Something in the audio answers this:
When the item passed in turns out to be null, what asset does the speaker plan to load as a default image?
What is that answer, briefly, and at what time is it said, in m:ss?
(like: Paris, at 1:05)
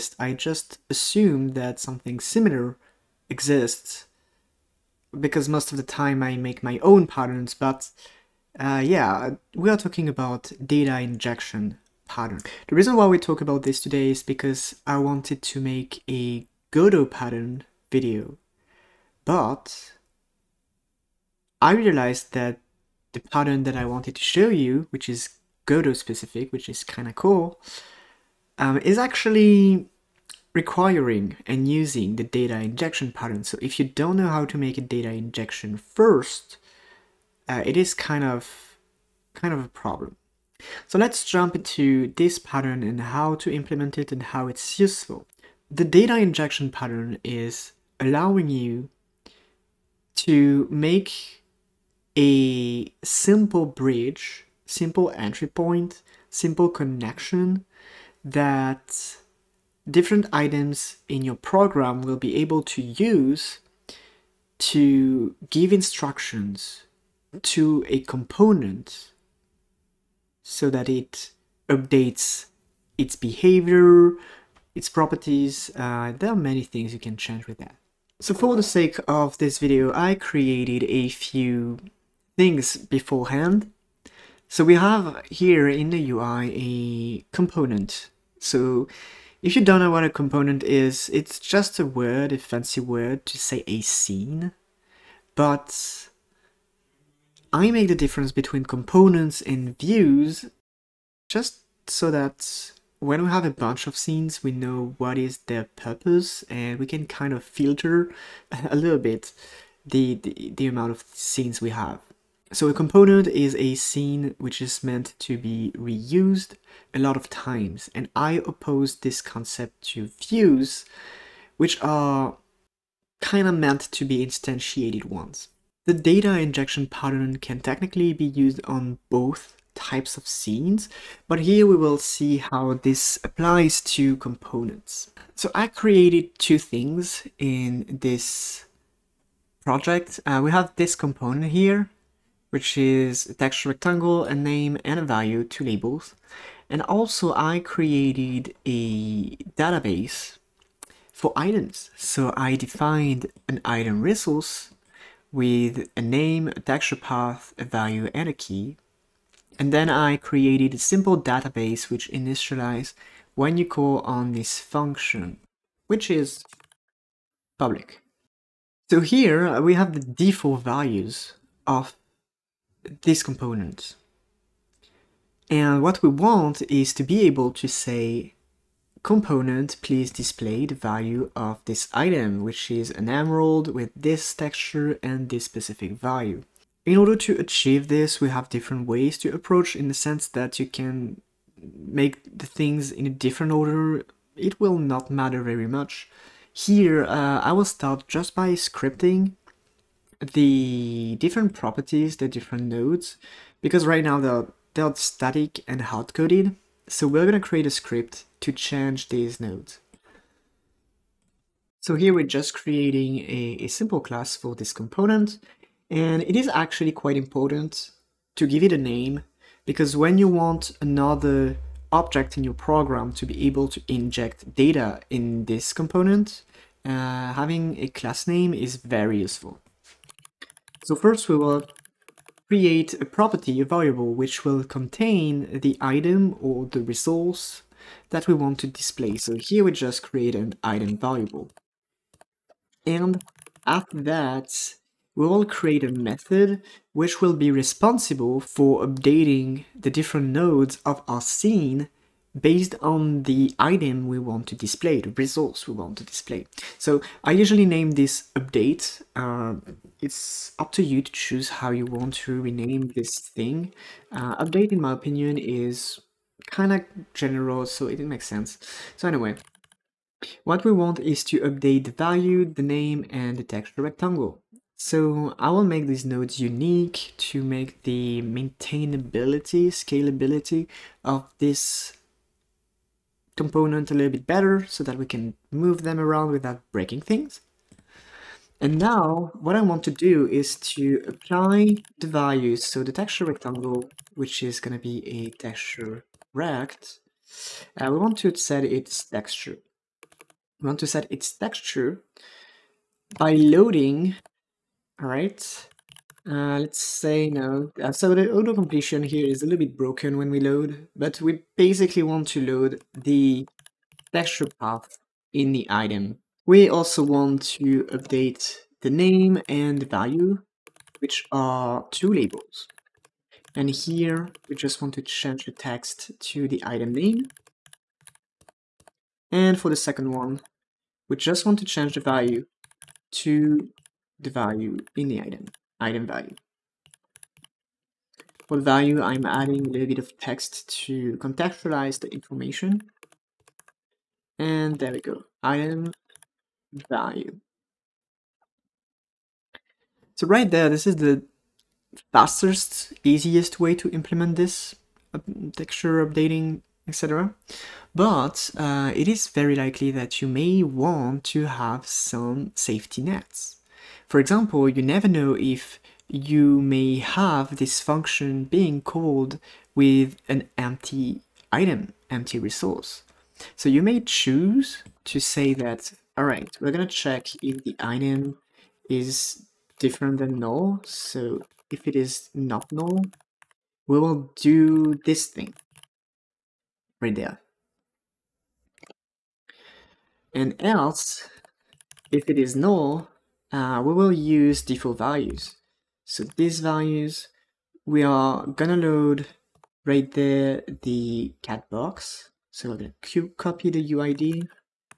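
the cat box, at 6:40.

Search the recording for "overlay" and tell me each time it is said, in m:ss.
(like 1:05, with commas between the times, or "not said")
not said.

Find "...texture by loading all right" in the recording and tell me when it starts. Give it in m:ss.
5:01.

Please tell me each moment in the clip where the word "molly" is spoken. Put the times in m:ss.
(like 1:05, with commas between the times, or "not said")
not said.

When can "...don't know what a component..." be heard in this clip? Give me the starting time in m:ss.
1:29.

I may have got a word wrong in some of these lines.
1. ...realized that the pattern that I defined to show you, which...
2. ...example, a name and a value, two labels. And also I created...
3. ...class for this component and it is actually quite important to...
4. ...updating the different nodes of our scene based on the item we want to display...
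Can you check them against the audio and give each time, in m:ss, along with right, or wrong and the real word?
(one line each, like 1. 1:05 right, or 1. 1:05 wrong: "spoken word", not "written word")
1. 0:21 wrong: "wanted", not "defined"
2. 2:23 wrong: "rectangle", not "example"
3. 3:34 right
4. 4:08 right.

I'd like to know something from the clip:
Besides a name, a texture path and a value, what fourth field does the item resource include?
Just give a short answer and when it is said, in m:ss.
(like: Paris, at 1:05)
key, at 2:38.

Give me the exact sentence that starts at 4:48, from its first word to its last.
And now what I want to do is to apply the values.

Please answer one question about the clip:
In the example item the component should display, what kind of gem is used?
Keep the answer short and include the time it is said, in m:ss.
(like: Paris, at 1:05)
emerald, at 3:02.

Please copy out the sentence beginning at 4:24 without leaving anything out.
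Uh, update, in my opinion, is kind of general, so it makes sense.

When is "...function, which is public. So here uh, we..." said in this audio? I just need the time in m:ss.
2:44.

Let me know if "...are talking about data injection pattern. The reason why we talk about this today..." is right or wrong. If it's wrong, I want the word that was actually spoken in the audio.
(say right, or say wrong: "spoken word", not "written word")
right.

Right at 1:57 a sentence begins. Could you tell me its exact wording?
And I oppose this concept to views, which are kind of meant to be instantiated once.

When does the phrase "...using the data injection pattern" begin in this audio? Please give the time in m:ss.
0:31.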